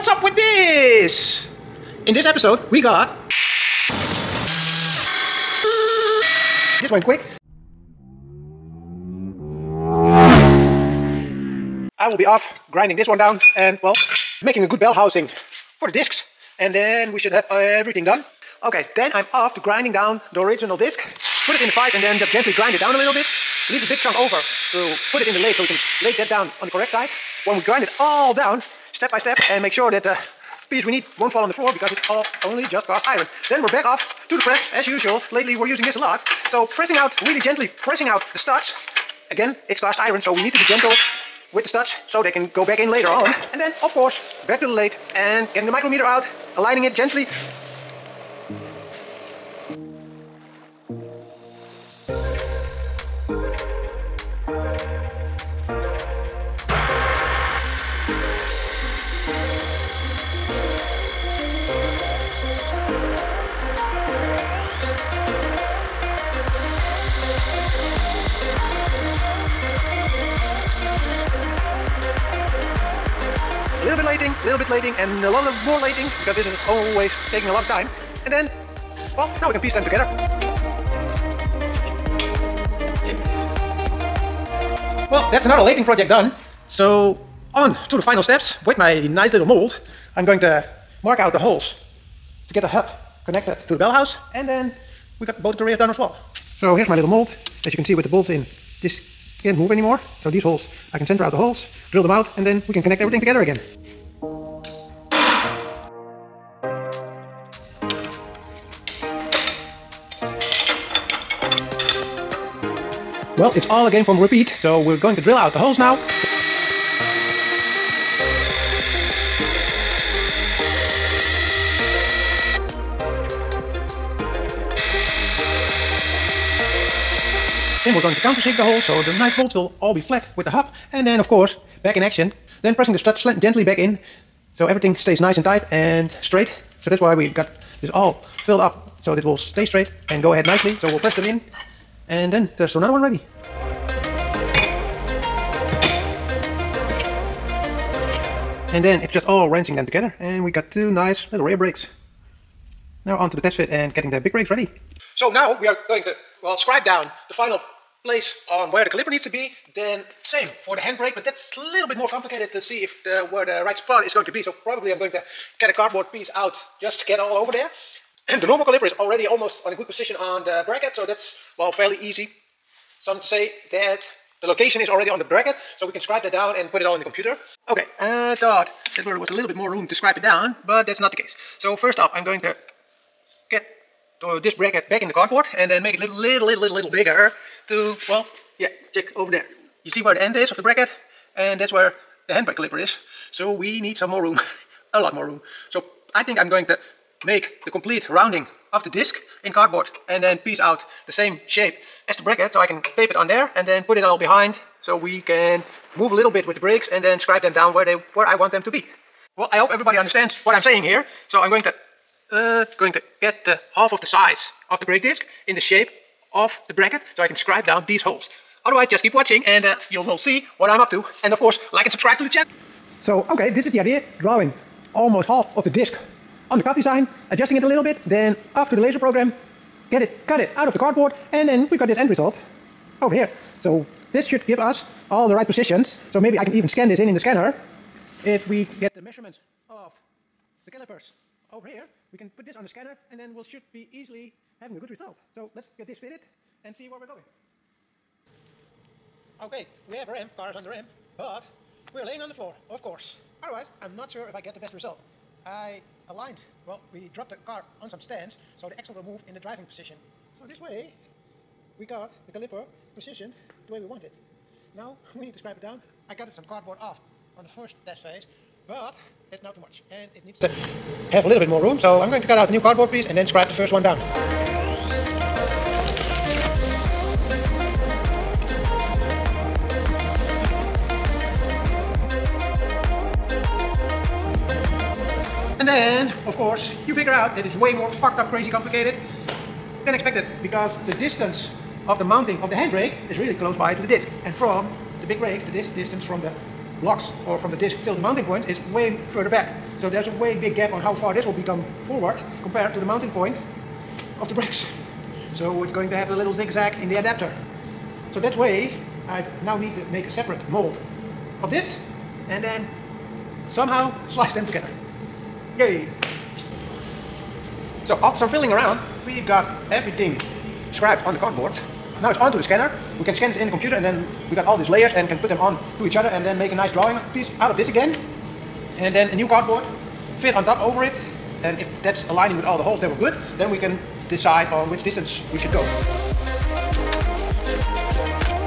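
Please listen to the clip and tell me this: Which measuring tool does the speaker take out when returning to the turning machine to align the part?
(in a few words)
micrometer.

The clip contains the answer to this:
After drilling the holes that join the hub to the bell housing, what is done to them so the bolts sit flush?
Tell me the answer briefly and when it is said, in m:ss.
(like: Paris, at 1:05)
countersink, at 2:08.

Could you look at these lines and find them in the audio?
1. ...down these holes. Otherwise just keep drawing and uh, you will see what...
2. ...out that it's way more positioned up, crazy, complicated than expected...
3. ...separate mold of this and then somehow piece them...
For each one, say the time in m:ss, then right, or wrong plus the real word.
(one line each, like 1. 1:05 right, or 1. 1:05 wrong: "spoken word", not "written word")
1. 3:37 wrong: "watching", not "drawing"
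2. 4:47 wrong: "fucked", not "positioned"
3. 5:10 wrong: "slice", not "piece".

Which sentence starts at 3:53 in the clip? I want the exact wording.
So this should give us all the right positions.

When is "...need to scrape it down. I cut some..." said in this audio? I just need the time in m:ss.
4:25.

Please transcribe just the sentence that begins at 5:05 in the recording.
So it's going to have a little zigzag in the adapter.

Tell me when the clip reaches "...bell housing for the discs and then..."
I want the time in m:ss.
0:14.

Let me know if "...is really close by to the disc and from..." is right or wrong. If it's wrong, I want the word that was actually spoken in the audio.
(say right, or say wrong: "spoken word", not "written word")
right.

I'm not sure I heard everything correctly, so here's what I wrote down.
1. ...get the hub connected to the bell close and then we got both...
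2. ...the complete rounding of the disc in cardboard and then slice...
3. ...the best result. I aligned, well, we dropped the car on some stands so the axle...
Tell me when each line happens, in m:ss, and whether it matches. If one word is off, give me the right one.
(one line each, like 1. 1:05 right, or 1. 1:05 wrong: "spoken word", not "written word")
1. 1:32 wrong: "house", not "close"
2. 3:17 wrong: "piece", not "slice"
3. 4:14 right.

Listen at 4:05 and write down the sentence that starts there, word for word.
So let's get this fitted and see where we're going.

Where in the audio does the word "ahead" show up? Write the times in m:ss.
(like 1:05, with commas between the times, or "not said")
2:20.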